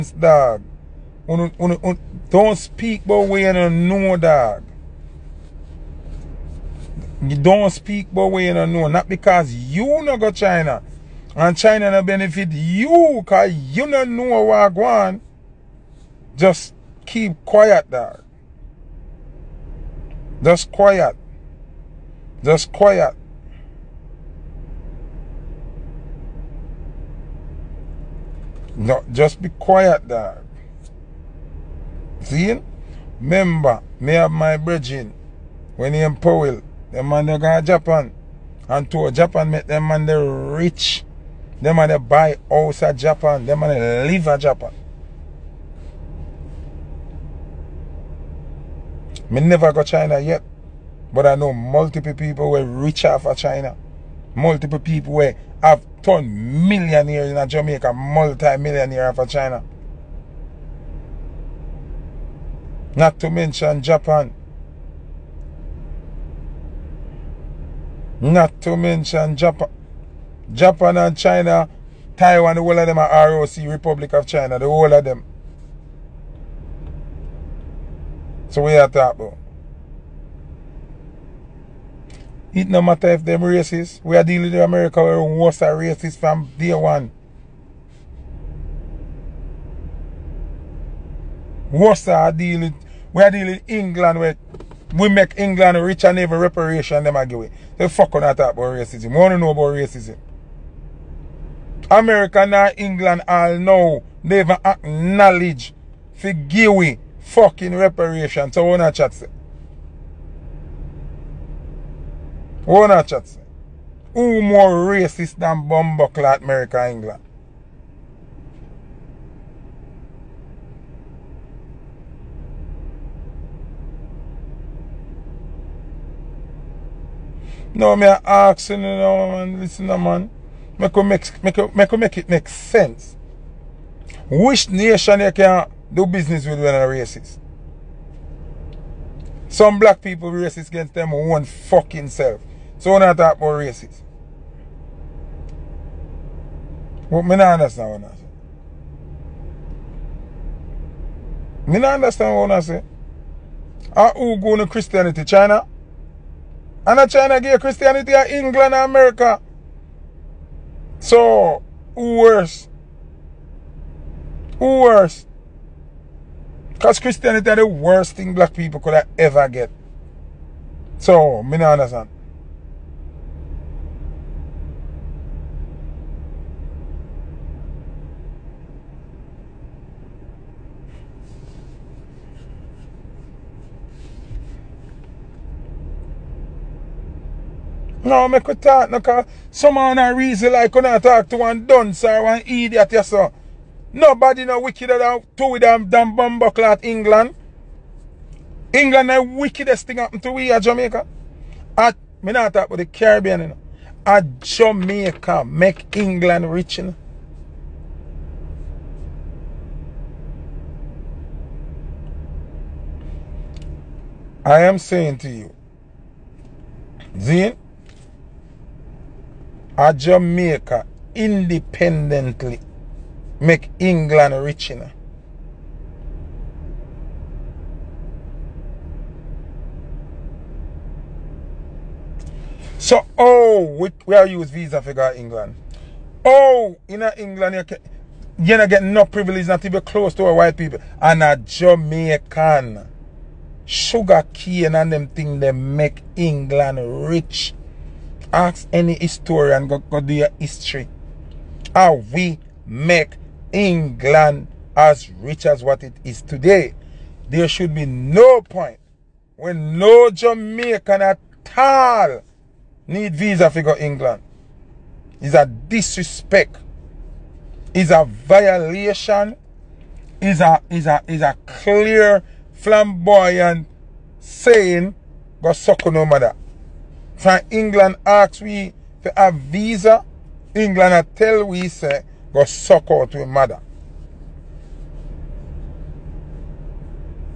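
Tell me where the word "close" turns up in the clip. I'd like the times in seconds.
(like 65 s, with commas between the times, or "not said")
239 s.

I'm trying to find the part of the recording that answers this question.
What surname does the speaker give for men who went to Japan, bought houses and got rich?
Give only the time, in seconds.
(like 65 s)
36 s.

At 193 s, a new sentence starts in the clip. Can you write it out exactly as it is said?
Nobody no wickeder than two with them damn bumbleclot England.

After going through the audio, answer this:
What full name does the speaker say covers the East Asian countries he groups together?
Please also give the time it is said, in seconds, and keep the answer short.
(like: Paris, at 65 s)
Republic of China, at 73 s.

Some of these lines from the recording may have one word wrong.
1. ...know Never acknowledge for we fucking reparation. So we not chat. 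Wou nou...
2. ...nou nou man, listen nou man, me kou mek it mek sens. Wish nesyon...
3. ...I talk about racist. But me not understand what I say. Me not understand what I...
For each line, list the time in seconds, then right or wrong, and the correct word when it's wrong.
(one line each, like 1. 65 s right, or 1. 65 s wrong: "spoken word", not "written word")
1. 103 s right
2. 128 s right
3. 143 s right.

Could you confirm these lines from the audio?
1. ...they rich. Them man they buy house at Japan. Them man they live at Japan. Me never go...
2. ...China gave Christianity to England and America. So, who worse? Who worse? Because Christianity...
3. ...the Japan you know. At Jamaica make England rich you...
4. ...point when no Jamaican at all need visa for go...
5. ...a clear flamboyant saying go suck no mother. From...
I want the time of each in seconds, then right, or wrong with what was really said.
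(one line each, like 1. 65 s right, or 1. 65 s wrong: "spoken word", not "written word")
1. 40 s right
2. 157 s right
3. 202 s wrong: "Caribbean", not "Japan"
4. 258 s right
5. 271 s wrong: "matter", not "mother".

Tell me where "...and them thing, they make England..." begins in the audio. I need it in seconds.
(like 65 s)
244 s.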